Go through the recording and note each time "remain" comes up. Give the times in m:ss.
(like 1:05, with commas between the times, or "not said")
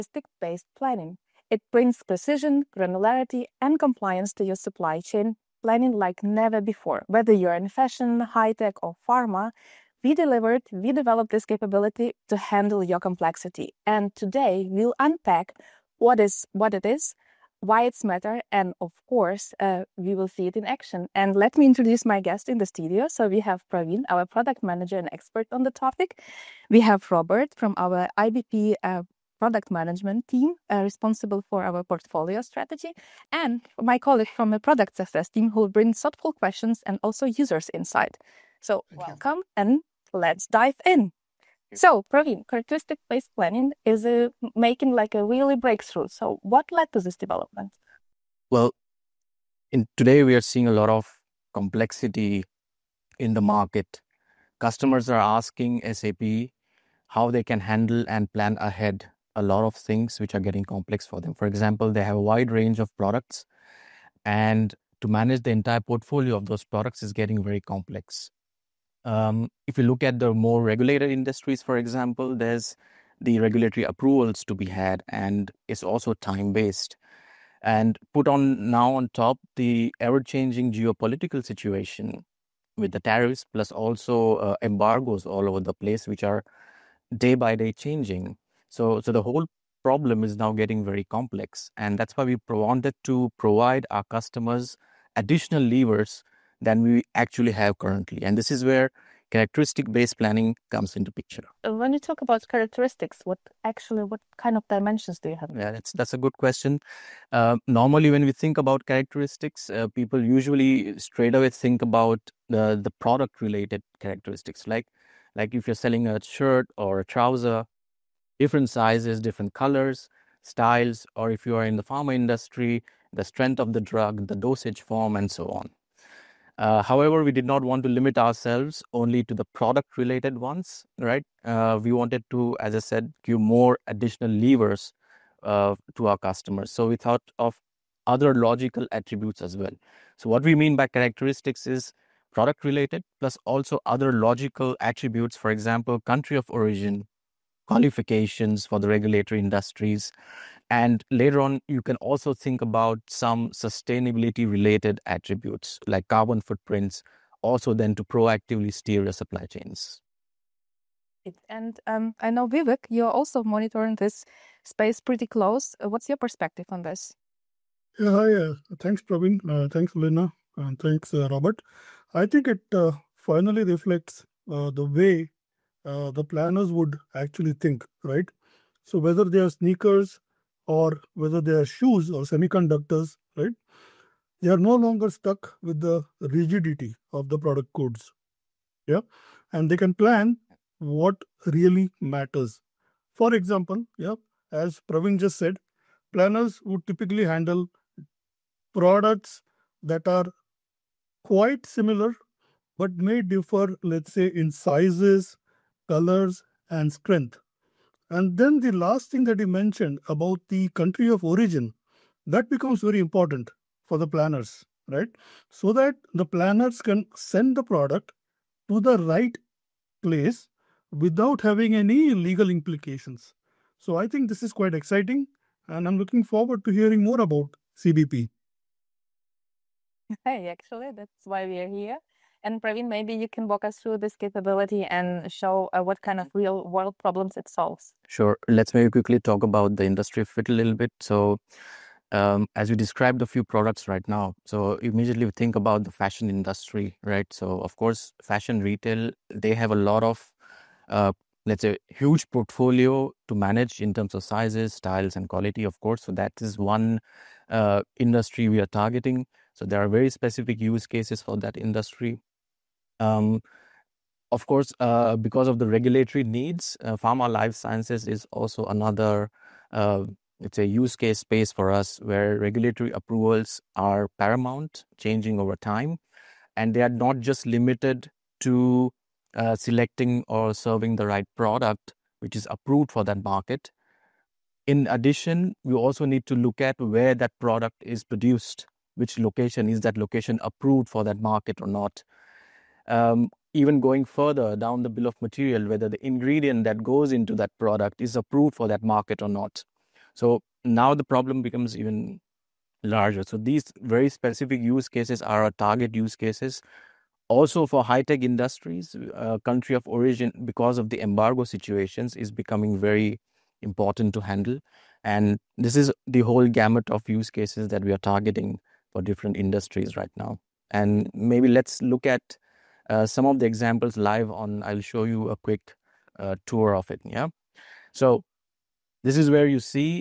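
not said.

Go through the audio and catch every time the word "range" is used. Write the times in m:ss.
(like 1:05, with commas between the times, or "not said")
1:02.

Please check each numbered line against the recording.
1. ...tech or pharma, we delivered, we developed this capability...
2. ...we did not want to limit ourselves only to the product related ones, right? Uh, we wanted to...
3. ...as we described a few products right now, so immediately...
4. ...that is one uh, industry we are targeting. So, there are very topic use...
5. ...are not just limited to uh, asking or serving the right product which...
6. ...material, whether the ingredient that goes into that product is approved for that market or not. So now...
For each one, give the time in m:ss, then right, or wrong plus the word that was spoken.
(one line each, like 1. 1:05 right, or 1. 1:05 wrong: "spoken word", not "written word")
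1. 0:08 right
2. 2:07 right
3. 4:02 right
4. 4:16 wrong: "specific", not "topic"
5. 4:36 wrong: "selecting", not "asking"
6. 4:55 right.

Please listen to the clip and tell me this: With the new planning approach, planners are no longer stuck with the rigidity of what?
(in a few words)
Product codes.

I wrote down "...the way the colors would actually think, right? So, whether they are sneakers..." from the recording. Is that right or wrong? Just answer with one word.
wrong.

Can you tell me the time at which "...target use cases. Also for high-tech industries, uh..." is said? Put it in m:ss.
5:05.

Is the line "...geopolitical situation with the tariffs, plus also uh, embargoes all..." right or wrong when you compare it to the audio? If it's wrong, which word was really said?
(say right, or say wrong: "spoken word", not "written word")
right.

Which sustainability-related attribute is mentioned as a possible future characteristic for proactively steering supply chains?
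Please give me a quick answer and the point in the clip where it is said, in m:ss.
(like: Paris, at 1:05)
Carbon footprints, at 2:36.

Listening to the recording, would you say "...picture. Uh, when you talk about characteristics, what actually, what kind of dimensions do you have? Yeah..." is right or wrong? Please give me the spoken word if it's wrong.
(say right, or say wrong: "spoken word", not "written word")
right.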